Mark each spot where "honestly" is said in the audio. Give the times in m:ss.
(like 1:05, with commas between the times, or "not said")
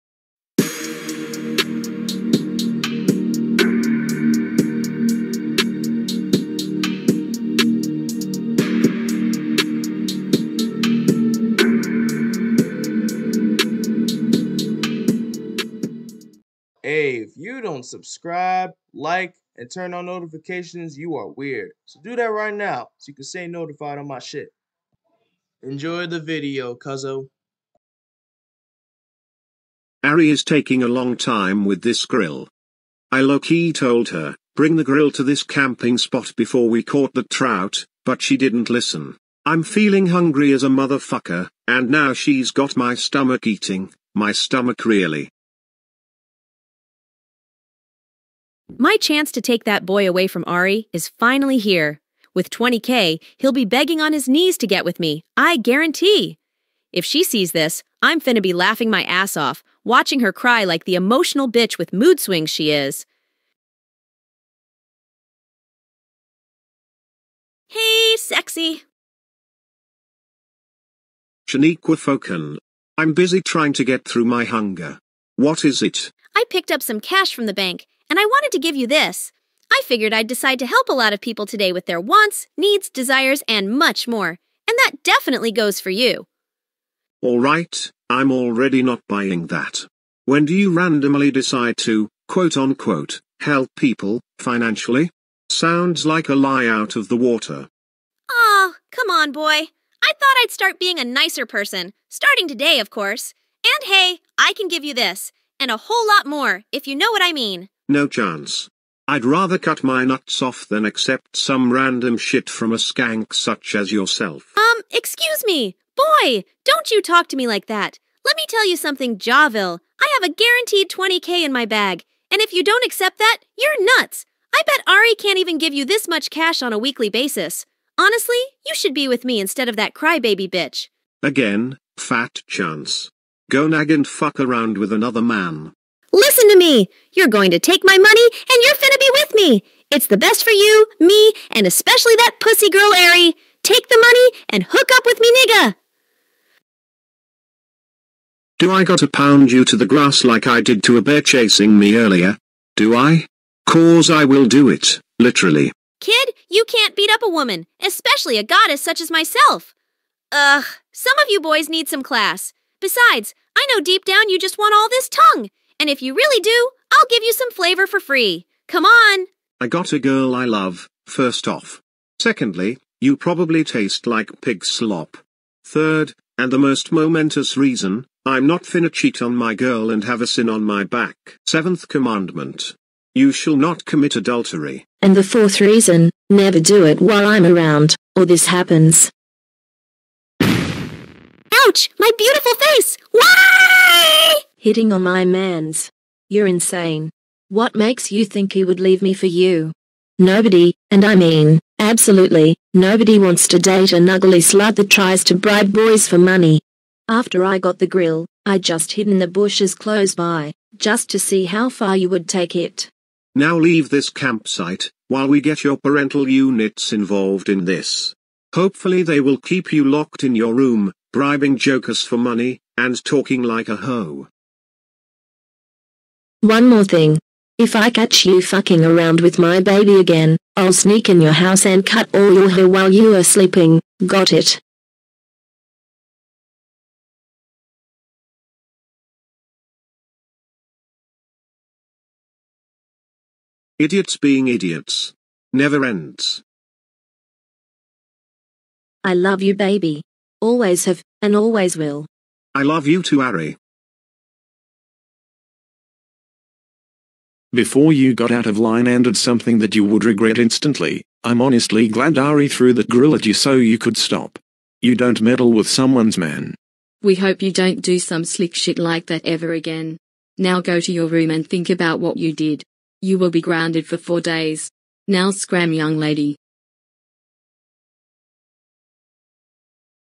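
2:07, 4:21.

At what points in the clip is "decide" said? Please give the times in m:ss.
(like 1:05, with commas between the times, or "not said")
1:20, 1:31.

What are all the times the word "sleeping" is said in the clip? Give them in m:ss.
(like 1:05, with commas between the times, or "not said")
3:53.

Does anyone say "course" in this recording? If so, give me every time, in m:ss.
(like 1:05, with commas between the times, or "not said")
1:42.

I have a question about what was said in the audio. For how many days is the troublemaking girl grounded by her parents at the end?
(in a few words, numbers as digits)
4.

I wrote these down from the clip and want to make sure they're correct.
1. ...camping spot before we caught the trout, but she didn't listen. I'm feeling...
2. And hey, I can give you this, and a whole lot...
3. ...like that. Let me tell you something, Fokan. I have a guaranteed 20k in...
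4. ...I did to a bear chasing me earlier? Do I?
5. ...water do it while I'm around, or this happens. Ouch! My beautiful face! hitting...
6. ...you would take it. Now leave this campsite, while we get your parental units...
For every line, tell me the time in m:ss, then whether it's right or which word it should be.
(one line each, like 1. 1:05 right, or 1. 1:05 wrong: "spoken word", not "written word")
1. 0:35 right
2. 1:43 right
3. 1:57 wrong: "Javil", not "Fokan"
4. 2:30 right
5. 3:06 wrong: "never", not "water"
6. 3:31 right.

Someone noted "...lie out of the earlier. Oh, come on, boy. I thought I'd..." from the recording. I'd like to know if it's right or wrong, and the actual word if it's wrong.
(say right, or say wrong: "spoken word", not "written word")
wrong: "water", not "earlier".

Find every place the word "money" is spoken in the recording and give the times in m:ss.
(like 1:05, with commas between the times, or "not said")
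2:17, 2:23, 3:26, 3:42.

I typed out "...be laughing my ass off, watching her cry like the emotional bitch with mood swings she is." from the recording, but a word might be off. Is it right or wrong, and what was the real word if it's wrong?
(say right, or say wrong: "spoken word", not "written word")
right.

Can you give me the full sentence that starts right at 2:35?
Kid, you can't beat up a woman, especially a goddess such as myself.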